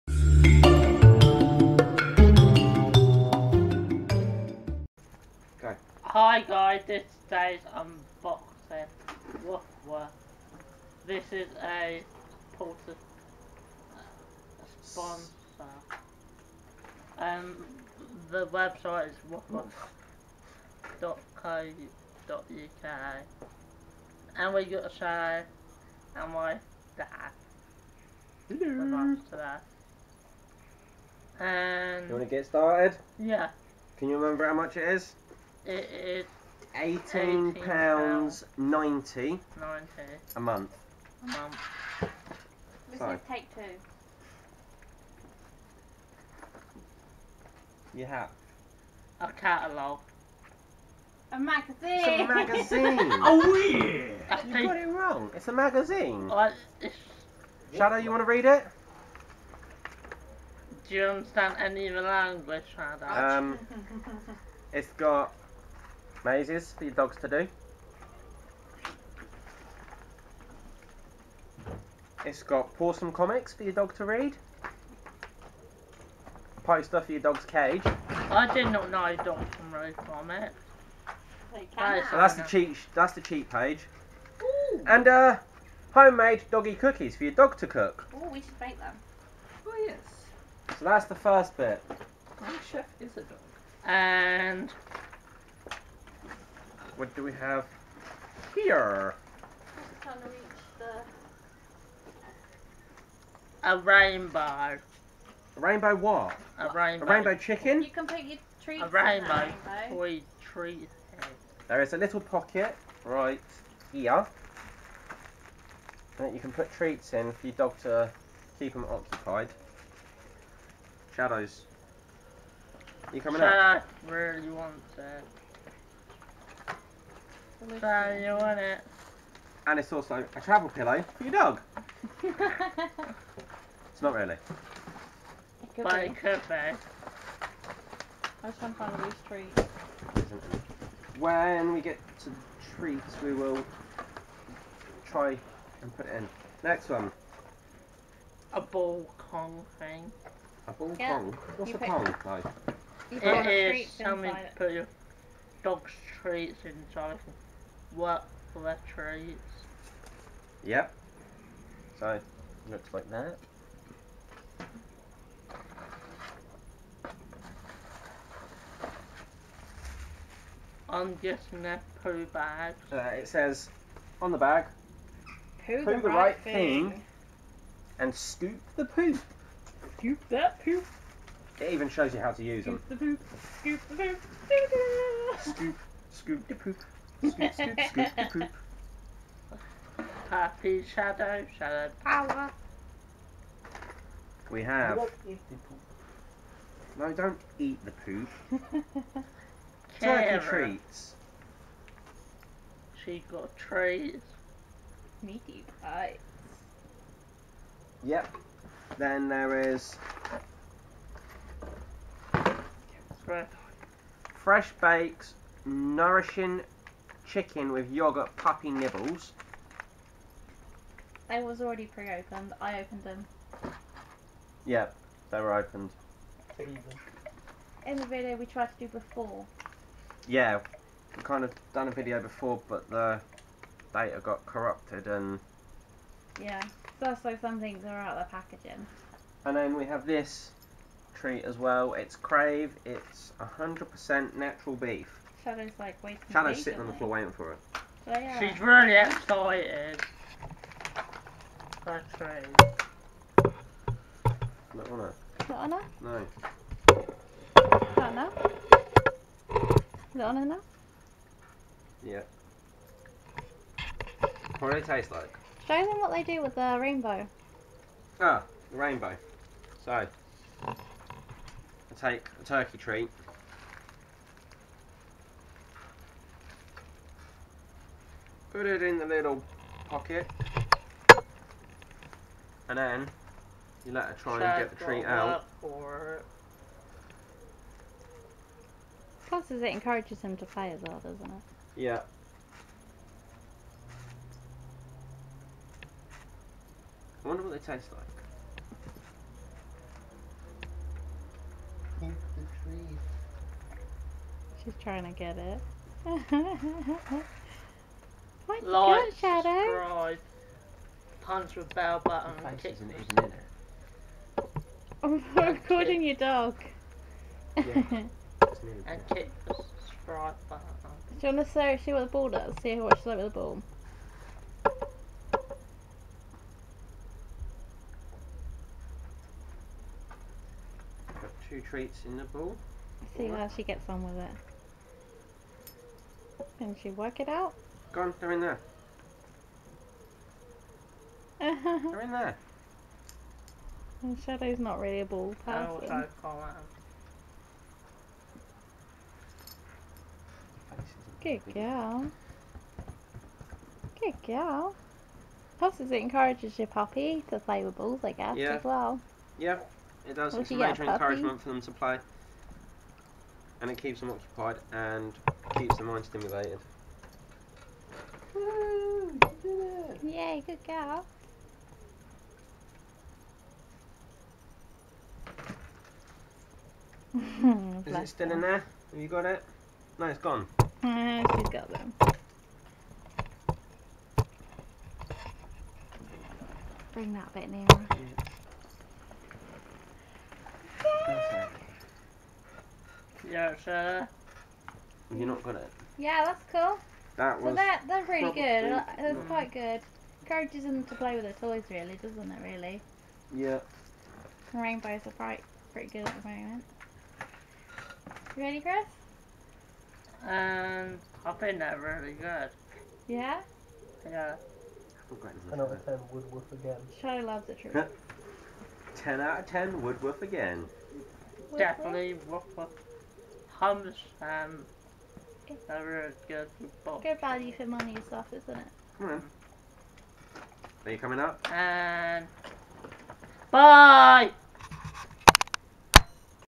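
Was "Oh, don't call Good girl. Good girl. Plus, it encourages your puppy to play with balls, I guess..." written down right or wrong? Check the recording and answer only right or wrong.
right.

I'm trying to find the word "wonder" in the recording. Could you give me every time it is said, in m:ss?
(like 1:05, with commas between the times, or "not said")
4:57.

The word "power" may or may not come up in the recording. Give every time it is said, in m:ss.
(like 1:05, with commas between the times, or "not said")
3:12.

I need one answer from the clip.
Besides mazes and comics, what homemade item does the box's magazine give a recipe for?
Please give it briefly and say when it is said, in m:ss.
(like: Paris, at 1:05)
doggy cookies, at 1:25.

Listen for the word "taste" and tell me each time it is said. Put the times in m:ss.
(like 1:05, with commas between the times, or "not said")
4:24, 4:57.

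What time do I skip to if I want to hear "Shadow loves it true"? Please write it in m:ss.
6:56.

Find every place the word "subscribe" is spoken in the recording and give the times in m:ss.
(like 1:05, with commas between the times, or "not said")
5:09, 5:19.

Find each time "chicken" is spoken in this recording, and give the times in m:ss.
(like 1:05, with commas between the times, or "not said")
1:47, 3:37.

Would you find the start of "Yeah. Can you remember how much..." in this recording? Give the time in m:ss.
0:33.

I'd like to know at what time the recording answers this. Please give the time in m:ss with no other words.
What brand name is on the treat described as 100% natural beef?
4:01.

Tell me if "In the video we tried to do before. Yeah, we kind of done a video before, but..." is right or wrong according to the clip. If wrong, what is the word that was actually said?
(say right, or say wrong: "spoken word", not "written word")
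right.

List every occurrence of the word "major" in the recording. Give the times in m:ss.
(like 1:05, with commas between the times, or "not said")
6:00.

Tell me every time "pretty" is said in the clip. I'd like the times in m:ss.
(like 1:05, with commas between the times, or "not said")
6:45.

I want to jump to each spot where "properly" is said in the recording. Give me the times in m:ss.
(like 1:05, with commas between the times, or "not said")
not said.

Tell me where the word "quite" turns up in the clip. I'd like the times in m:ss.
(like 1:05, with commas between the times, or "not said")
6:39, 6:45.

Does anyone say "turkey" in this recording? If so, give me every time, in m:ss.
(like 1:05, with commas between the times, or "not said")
3:19, 4:32.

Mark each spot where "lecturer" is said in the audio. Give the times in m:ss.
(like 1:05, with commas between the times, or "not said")
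2:38.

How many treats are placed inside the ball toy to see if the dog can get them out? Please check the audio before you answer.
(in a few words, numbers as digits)
2.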